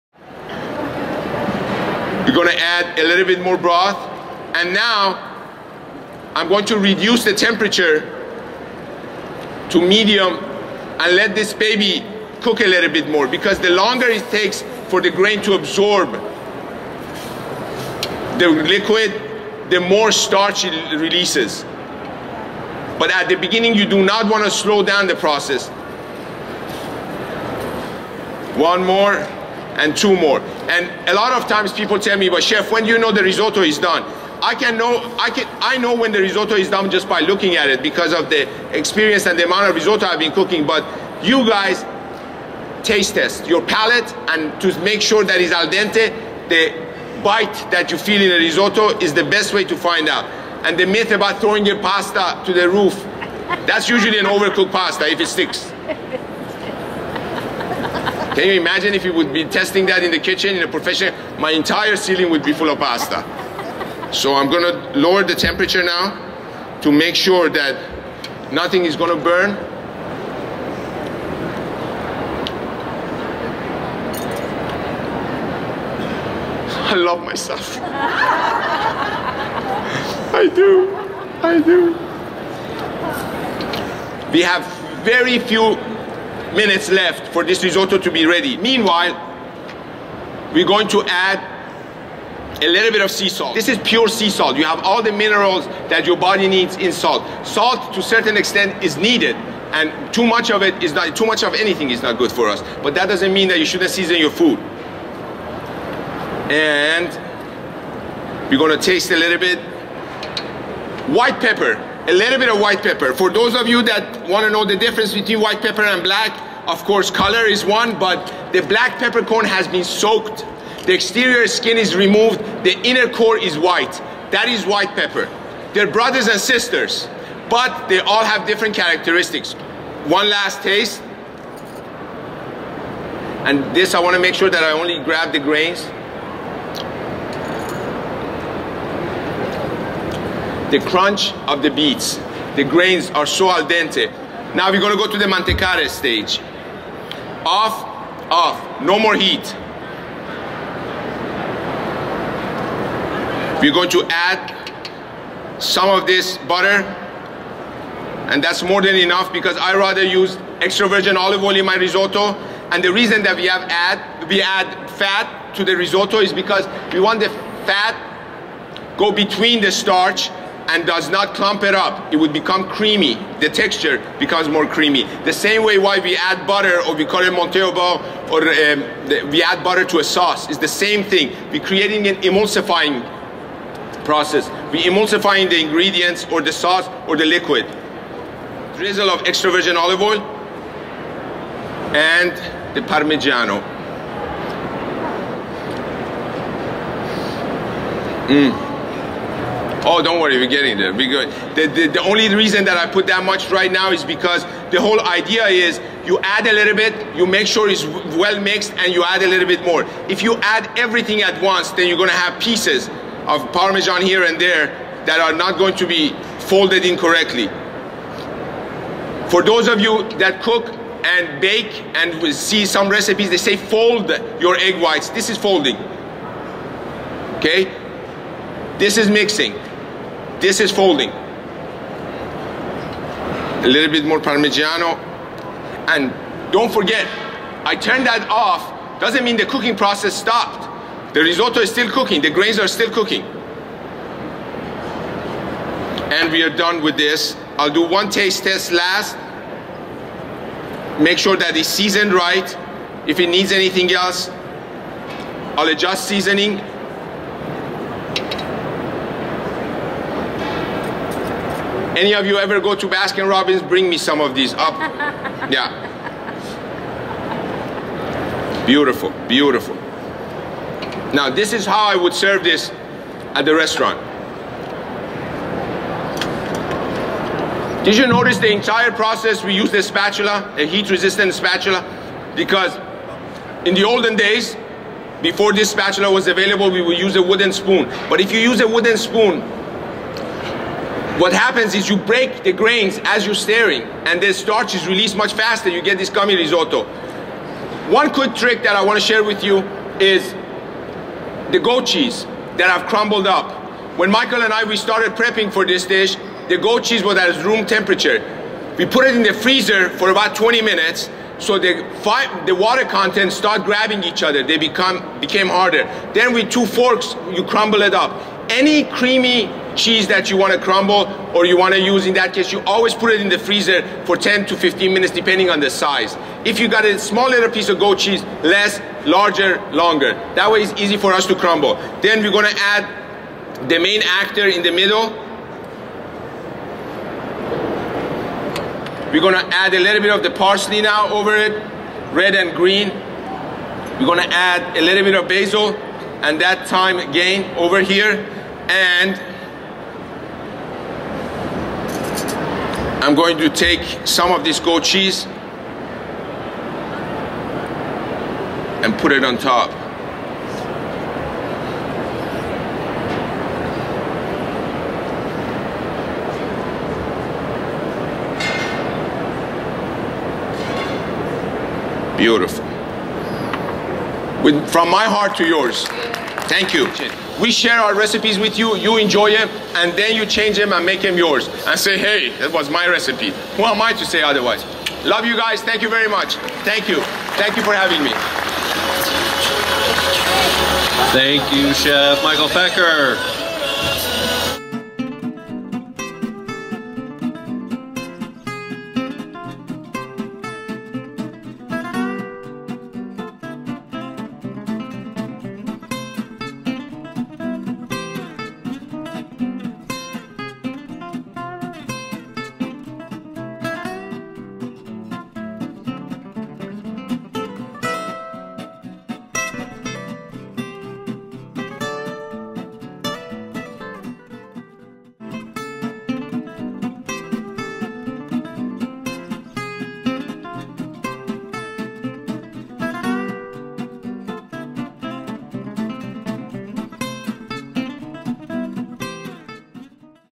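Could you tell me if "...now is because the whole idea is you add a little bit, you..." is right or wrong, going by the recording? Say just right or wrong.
right.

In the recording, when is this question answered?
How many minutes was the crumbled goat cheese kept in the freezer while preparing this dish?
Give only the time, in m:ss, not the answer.
5:10.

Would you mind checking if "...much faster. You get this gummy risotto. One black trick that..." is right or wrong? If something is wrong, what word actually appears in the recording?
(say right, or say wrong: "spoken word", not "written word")
wrong: "quick", not "black".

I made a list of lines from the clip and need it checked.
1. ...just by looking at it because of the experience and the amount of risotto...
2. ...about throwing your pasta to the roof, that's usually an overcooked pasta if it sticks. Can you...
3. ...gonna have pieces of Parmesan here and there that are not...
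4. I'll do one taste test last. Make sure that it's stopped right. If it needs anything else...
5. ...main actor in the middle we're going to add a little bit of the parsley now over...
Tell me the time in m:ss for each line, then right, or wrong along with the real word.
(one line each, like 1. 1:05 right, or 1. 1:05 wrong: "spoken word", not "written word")
1. 0:36 right
2. 0:51 right
3. 3:31 right
4. 4:07 wrong: "seasoned", not "stopped"
5. 5:33 right.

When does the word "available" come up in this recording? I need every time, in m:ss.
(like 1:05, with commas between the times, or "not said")
4:46.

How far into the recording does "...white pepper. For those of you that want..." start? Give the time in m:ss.
1:52.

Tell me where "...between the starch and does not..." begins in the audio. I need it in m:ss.
2:49.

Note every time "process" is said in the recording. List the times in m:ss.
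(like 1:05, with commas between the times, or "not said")
0:25, 3:04, 3:59, 4:38.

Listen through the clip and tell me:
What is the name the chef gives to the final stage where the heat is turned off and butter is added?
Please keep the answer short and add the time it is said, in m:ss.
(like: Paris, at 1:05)
mantecare, at 2:25.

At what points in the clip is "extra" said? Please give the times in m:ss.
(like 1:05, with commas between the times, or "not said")
2:40, 3:09.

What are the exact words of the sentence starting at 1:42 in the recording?
But that doesn't mean that you shouldn't season your food.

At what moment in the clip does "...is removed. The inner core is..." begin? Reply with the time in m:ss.
2:01.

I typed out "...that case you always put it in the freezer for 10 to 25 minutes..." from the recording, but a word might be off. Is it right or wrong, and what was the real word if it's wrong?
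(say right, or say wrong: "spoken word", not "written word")
wrong: "15", not "25".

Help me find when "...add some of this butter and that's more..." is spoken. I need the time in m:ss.
2:34.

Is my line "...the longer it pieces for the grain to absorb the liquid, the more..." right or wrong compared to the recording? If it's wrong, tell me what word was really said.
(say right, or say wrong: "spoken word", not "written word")
wrong: "takes", not "pieces".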